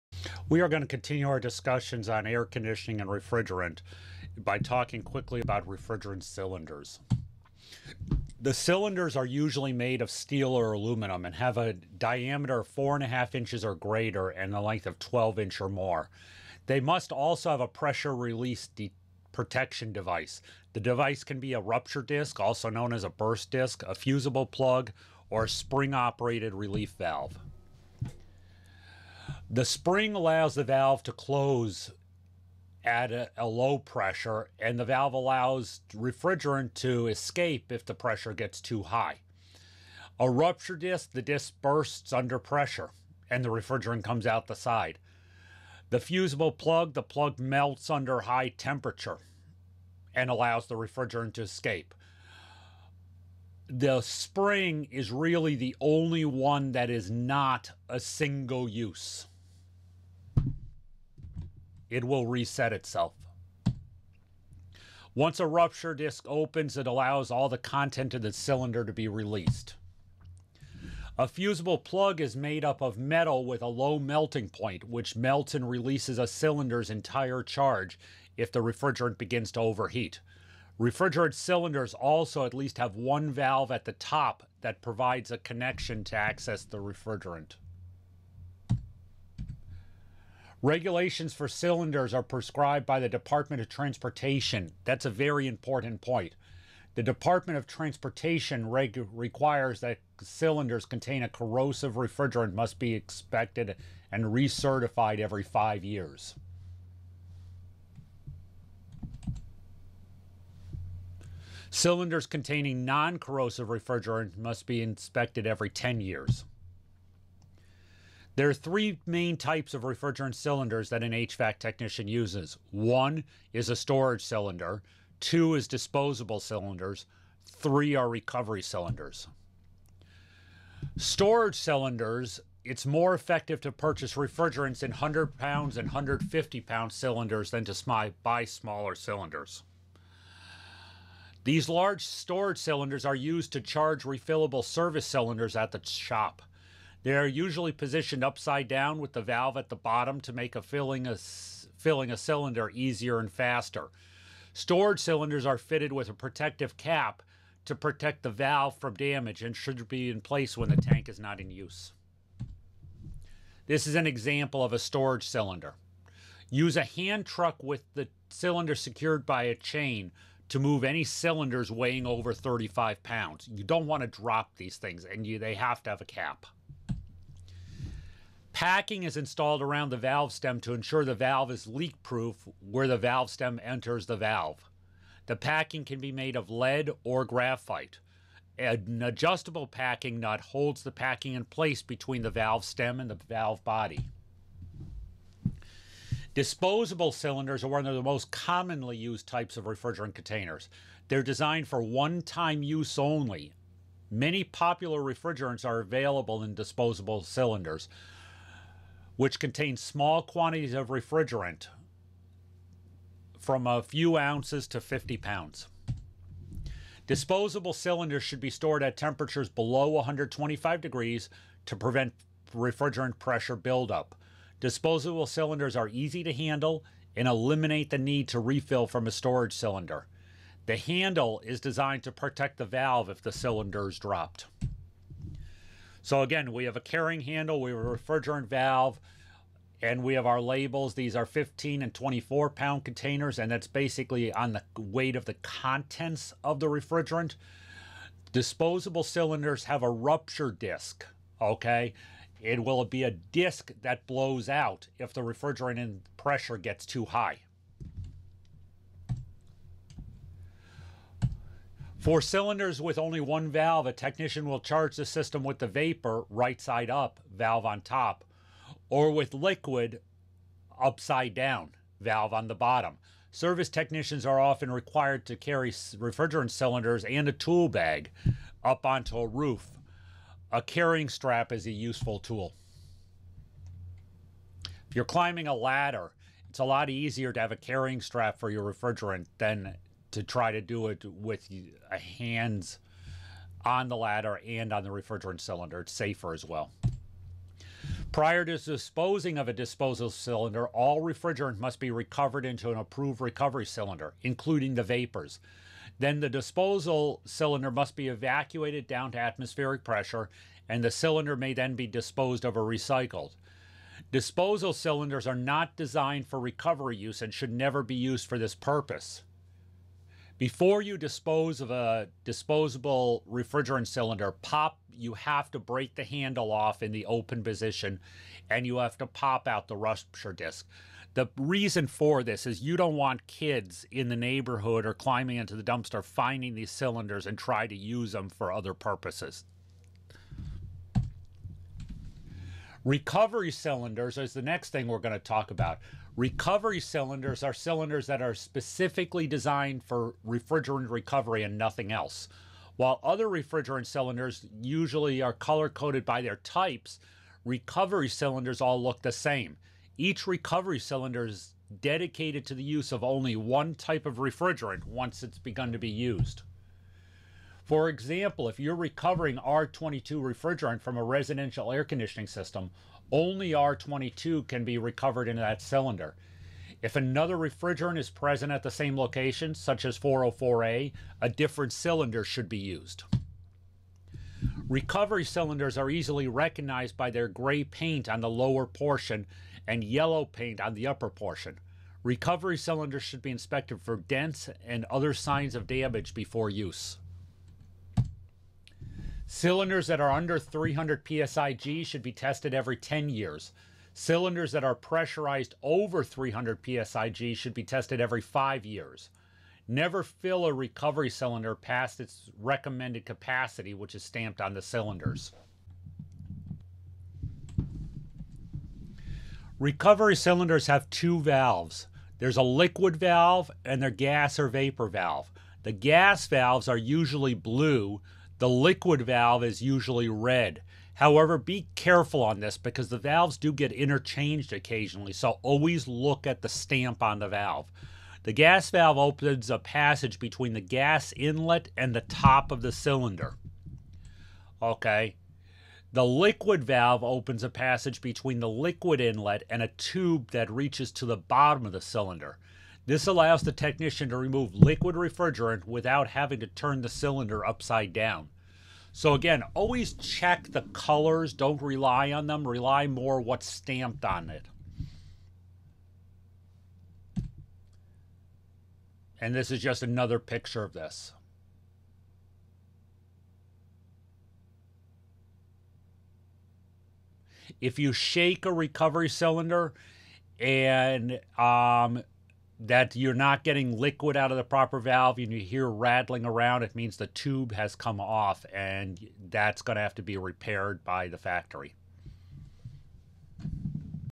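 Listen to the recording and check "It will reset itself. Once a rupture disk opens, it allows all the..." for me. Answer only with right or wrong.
right.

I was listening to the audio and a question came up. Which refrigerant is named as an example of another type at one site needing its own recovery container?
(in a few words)
404A.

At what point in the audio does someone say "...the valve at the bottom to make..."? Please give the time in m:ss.
2:29.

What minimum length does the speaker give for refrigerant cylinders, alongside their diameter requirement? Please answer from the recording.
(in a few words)
12 inches.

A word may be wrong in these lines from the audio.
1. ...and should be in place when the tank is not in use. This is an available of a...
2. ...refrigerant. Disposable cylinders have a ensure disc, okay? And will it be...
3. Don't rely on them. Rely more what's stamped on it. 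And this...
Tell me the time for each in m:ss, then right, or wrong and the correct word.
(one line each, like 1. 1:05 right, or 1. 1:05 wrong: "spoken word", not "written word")
1. 2:39 wrong: "example", not "available"
2. 4:06 wrong: "rupture", not "ensure"
3. 7:41 right.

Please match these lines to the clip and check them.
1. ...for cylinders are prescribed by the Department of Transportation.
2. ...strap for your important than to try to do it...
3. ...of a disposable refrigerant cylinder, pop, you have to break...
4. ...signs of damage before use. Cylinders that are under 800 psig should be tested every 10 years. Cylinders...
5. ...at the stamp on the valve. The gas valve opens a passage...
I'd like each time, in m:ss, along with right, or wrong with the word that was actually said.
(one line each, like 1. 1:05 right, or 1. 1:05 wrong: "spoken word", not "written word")
1. 1:31 right
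2. 4:48 wrong: "refrigerant", not "important"
3. 5:21 right
4. 6:35 wrong: "300", not "800"
5. 7:16 right.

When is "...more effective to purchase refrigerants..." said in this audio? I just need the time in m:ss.
2:12.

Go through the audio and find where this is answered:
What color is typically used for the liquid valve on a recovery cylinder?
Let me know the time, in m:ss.
7:10.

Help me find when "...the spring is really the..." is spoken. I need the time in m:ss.
0:53.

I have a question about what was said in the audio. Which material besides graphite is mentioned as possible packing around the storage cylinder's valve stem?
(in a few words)
lead.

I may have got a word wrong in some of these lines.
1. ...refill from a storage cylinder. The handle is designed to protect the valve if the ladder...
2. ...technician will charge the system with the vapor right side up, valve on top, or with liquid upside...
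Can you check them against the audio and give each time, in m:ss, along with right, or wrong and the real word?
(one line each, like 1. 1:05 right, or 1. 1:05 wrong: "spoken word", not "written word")
1. 3:48 wrong: "cylinder", not "ladder"
2. 4:23 right.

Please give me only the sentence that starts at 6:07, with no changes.
For example, if you're recovering R22 refrigerant from a residential air conditioning system, only R22 can be recovered in that cylinder.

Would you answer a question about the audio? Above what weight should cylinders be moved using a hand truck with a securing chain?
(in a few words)
35 pounds.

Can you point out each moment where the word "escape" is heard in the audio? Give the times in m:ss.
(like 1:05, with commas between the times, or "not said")
0:37, 0:51.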